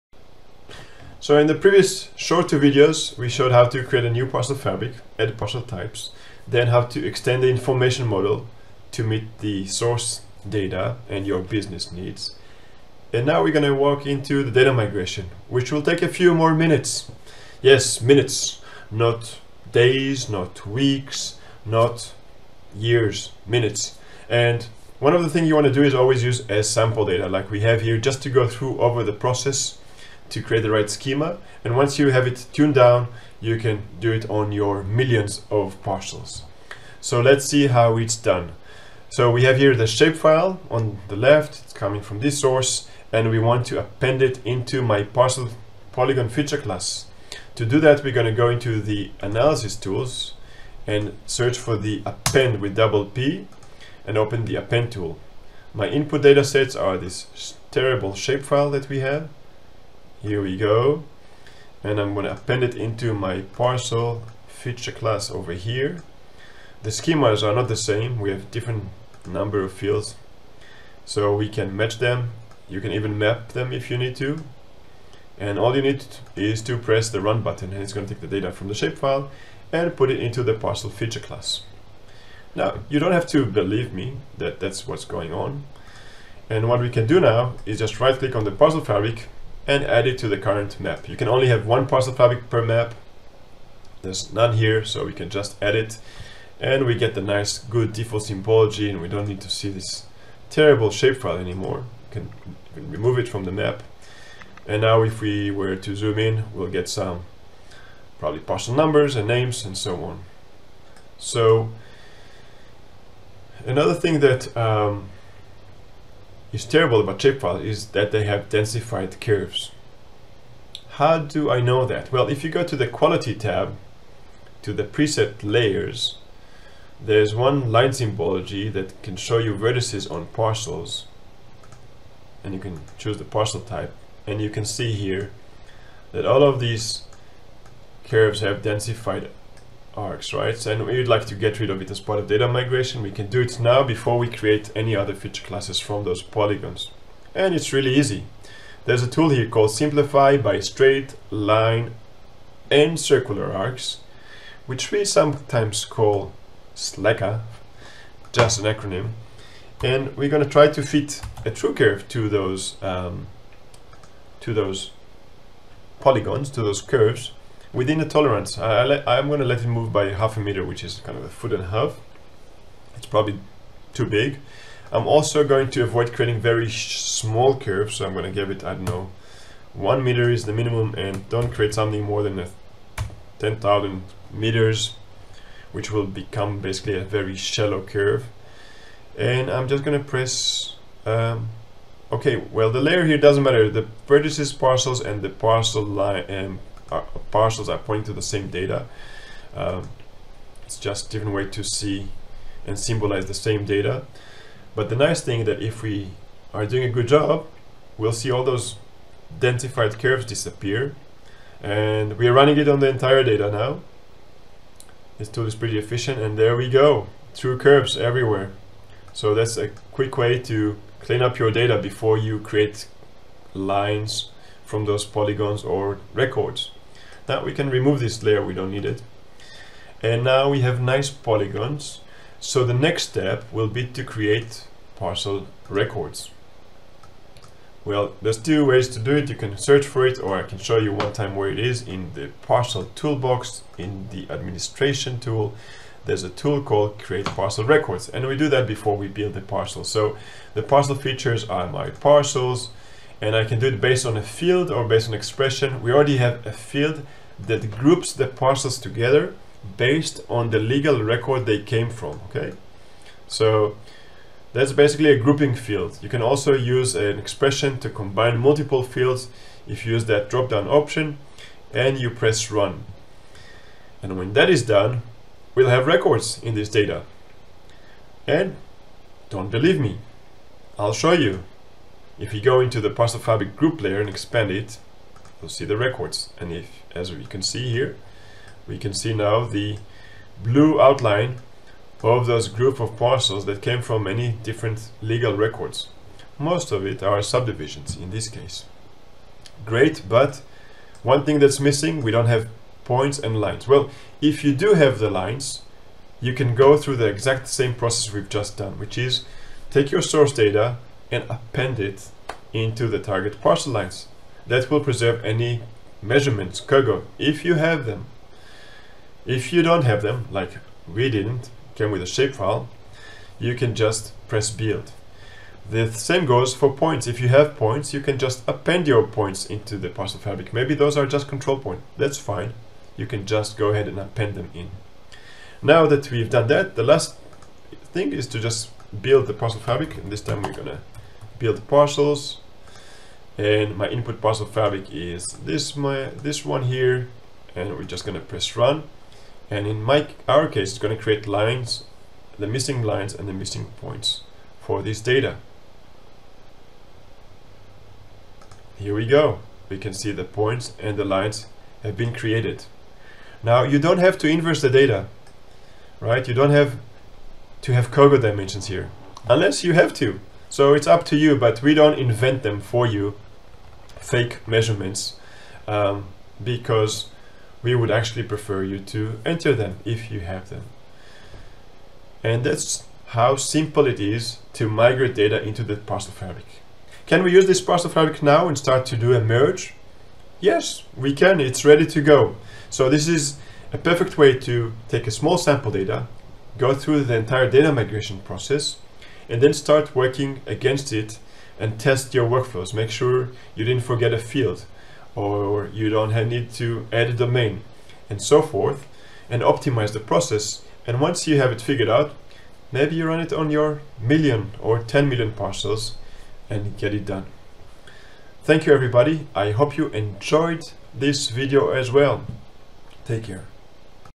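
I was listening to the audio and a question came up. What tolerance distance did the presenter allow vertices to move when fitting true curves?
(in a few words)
half a meter.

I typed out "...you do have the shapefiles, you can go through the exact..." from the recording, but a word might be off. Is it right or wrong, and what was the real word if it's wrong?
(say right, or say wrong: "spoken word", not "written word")
wrong: "lines", not "shapefiles".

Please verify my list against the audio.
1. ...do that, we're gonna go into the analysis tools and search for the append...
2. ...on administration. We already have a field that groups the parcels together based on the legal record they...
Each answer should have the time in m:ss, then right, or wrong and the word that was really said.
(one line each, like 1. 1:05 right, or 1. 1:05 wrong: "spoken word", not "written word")
1. 0:47 right
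2. 4:15 wrong: "expression", not "administration".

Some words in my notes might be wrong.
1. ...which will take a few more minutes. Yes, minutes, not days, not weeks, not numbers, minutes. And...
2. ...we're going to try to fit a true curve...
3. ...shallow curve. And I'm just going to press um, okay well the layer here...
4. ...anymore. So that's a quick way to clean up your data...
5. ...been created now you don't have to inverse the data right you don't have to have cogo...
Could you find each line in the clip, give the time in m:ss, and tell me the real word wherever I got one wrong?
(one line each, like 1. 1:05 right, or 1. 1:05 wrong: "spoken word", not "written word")
1. 0:15 wrong: "years", not "numbers"
2. 2:40 right
3. 3:07 right
4. 3:37 wrong: "everywhere", not "anymore"
5. 6:01 right.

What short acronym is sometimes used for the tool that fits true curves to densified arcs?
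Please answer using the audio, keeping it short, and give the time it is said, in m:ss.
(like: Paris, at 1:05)
SLECA, at 2:36.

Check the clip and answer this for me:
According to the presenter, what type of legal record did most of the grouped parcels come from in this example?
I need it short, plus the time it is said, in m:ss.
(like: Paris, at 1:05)
subdivisions, at 4:57.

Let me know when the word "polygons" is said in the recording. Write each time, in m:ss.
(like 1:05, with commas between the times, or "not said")
0:45, 2:26, 2:45, 3:45, 3:51.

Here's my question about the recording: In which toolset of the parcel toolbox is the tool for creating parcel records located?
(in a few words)
administration.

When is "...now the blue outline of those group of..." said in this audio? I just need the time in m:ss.
4:49.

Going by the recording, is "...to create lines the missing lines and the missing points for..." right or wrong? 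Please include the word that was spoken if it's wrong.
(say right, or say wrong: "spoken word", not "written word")
right.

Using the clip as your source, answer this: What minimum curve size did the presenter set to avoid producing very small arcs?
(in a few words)
1 meter.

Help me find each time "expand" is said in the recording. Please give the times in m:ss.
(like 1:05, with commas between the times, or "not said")
4:44.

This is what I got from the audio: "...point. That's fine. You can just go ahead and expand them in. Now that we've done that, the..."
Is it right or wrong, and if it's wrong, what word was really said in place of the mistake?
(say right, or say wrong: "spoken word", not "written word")
wrong: "append", not "expand".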